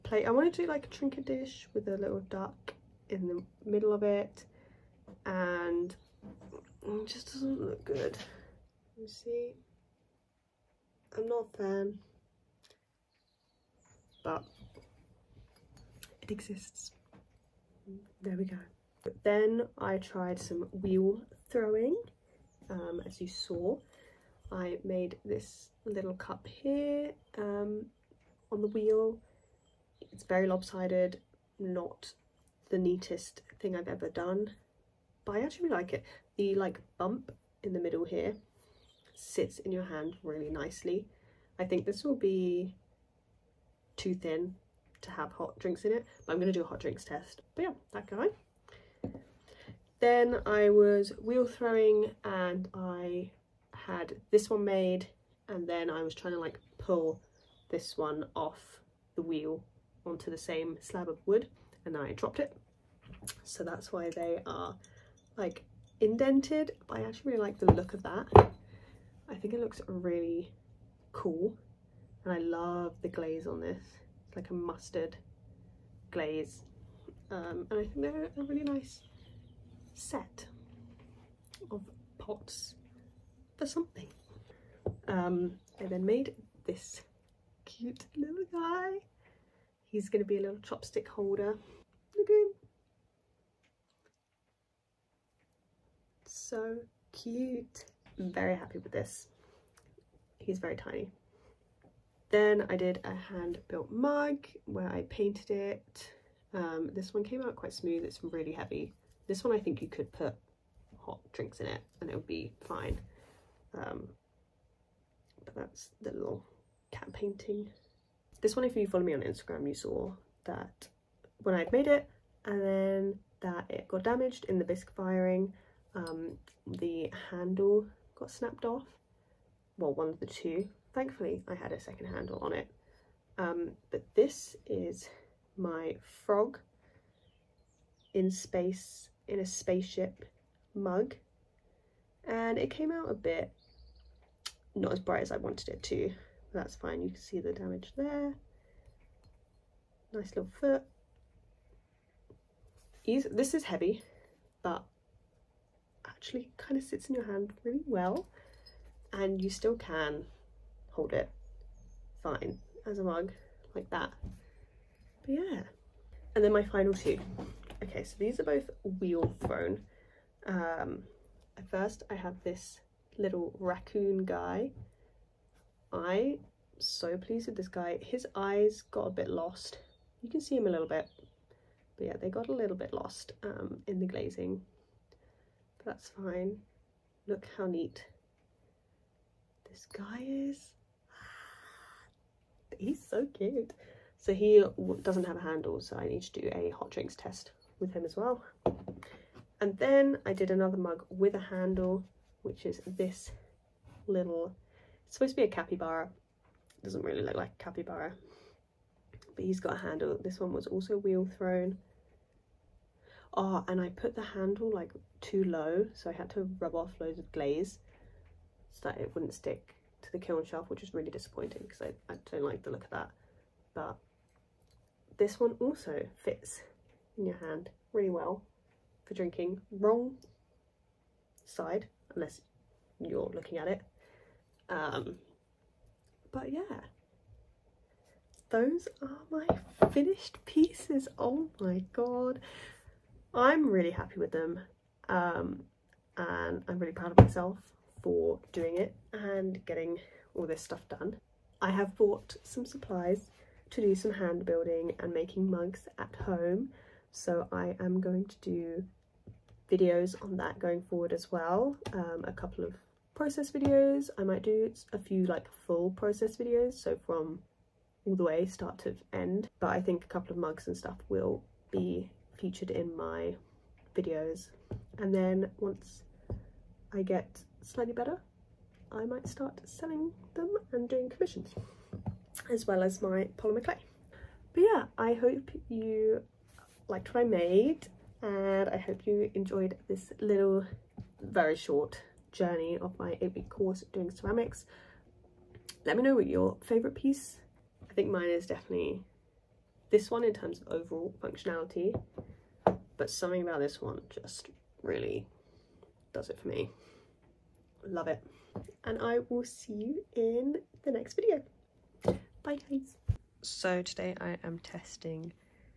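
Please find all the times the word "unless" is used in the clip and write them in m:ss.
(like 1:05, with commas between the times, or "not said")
3:52.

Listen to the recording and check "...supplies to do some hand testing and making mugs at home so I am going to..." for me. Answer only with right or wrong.
wrong.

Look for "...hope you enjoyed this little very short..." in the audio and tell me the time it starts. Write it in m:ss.
4:48.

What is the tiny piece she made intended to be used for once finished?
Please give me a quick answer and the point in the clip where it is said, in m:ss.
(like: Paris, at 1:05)
chopstick holder, at 1:30.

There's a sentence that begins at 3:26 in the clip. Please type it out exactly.
It doesn't really look like a capybara, but he's got a handle.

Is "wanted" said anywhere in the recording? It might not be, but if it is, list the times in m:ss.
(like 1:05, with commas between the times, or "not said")
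0:00, 2:25.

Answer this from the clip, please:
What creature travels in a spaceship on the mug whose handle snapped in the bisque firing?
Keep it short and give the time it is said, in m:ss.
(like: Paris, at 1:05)
frog, at 2:15.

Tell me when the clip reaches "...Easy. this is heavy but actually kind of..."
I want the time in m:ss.
2:33.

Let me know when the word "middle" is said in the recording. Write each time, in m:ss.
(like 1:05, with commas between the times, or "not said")
0:03, 0:37.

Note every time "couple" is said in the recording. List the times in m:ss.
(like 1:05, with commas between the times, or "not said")
4:22, 4:30.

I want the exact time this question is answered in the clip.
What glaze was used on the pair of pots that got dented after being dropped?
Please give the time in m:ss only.
1:14.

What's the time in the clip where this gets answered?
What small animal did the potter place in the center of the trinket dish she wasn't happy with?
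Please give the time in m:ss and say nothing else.
0:01.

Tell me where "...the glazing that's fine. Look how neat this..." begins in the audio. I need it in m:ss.
3:03.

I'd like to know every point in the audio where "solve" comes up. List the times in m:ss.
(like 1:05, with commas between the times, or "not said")
not said.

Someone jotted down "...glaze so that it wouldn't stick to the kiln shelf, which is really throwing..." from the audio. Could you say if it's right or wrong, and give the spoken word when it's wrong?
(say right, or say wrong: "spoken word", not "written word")
wrong: "disappointing", not "throwing".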